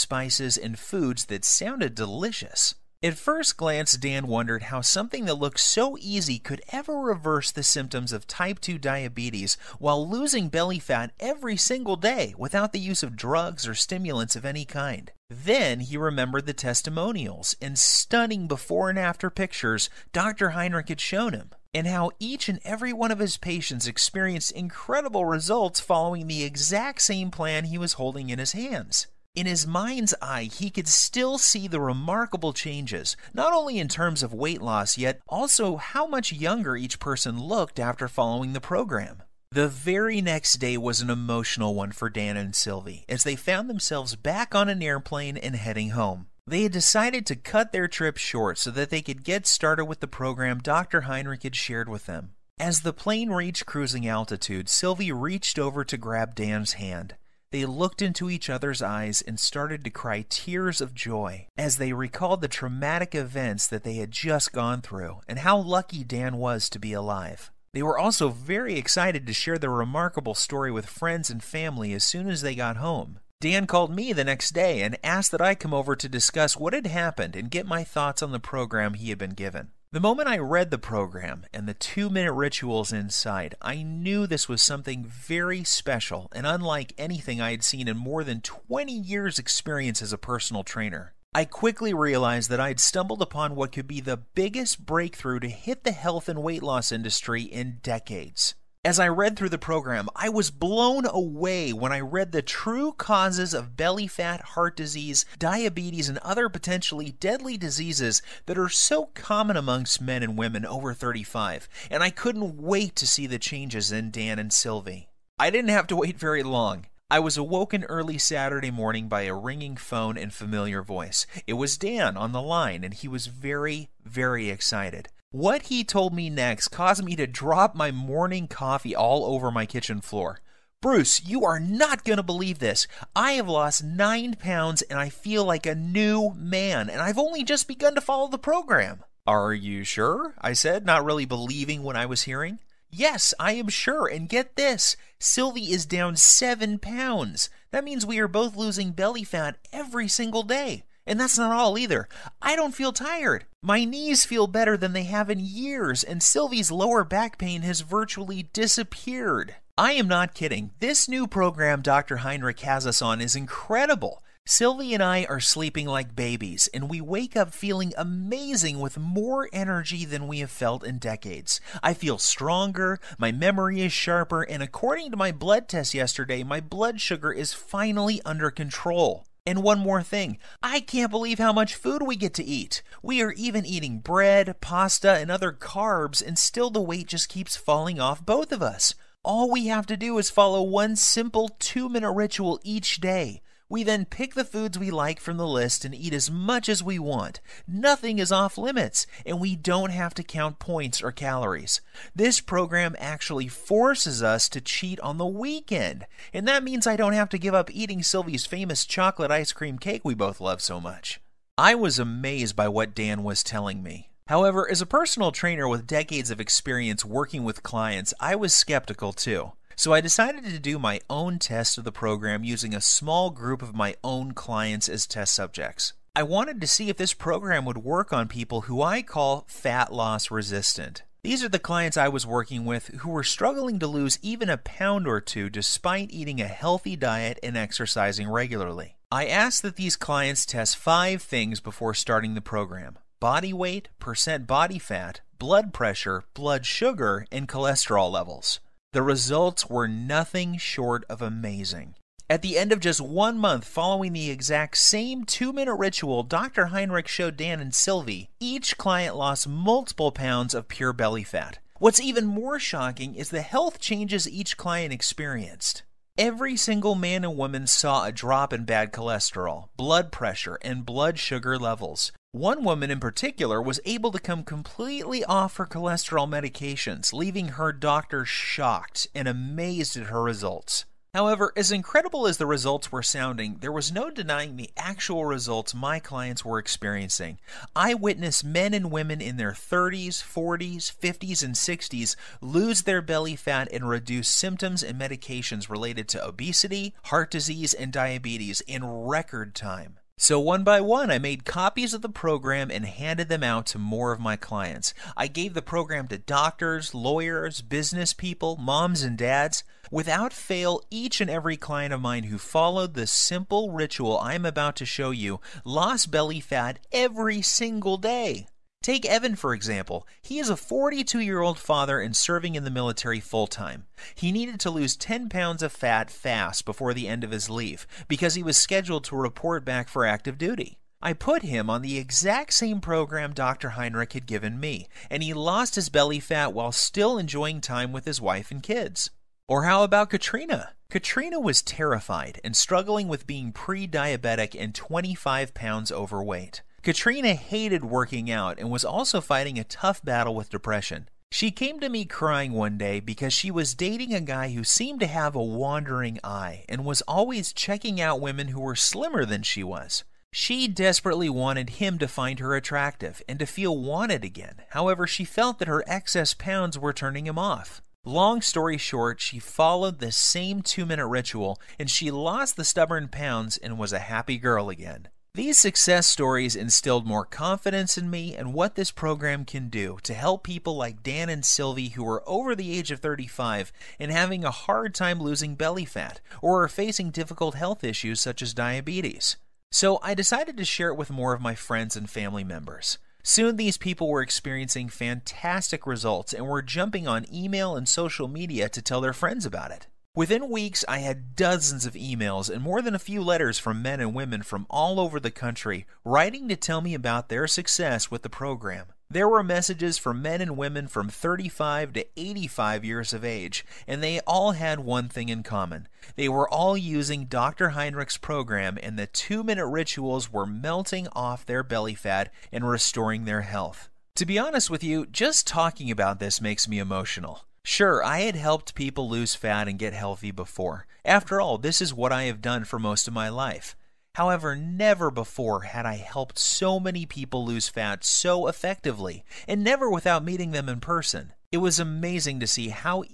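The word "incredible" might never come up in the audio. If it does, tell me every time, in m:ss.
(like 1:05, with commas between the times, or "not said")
0:24, 2:43, 4:41.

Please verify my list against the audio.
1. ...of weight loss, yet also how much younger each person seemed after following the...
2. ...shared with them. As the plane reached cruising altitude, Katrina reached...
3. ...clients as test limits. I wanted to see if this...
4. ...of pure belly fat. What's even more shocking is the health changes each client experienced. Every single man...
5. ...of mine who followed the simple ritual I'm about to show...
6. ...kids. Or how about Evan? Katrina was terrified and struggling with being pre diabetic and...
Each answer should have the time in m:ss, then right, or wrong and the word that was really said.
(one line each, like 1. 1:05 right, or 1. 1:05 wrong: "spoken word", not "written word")
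1. 0:34 wrong: "looked", not "seemed"
2. 0:51 wrong: "Sylvie", not "Katrina"
3. 3:44 wrong: "subjects", not "limits"
4. 4:20 right
5. 5:11 right
6. 5:38 wrong: "Katrina", not "Evan".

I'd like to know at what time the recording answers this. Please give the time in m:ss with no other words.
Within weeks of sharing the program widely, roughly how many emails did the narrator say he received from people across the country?
6:41.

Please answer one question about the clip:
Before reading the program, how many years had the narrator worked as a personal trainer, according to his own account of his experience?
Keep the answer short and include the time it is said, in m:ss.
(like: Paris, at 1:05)
20, at 1:28.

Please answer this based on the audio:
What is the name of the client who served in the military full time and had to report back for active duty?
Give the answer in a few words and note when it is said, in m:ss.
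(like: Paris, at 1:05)
Evan, at 5:19.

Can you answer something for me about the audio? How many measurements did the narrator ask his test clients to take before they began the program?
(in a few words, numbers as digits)
5.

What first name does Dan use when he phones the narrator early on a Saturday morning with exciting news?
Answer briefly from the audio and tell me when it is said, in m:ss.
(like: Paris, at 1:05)
Bruce, at 2:10.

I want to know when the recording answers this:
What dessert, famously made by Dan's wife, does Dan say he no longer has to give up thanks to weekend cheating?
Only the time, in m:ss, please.
3:28.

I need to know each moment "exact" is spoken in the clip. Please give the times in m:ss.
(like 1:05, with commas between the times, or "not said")
0:26, 4:14, 5:31.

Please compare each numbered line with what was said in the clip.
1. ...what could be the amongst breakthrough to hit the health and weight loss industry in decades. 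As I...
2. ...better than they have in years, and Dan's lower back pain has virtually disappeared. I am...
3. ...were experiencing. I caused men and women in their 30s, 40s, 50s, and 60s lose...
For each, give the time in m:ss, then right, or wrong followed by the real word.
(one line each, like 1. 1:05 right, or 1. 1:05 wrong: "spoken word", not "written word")
1. 1:33 wrong: "biggest", not "amongst"
2. 2:34 wrong: "Sylvie", not "Dan"
3. 4:46 wrong: "witnessed", not "caused".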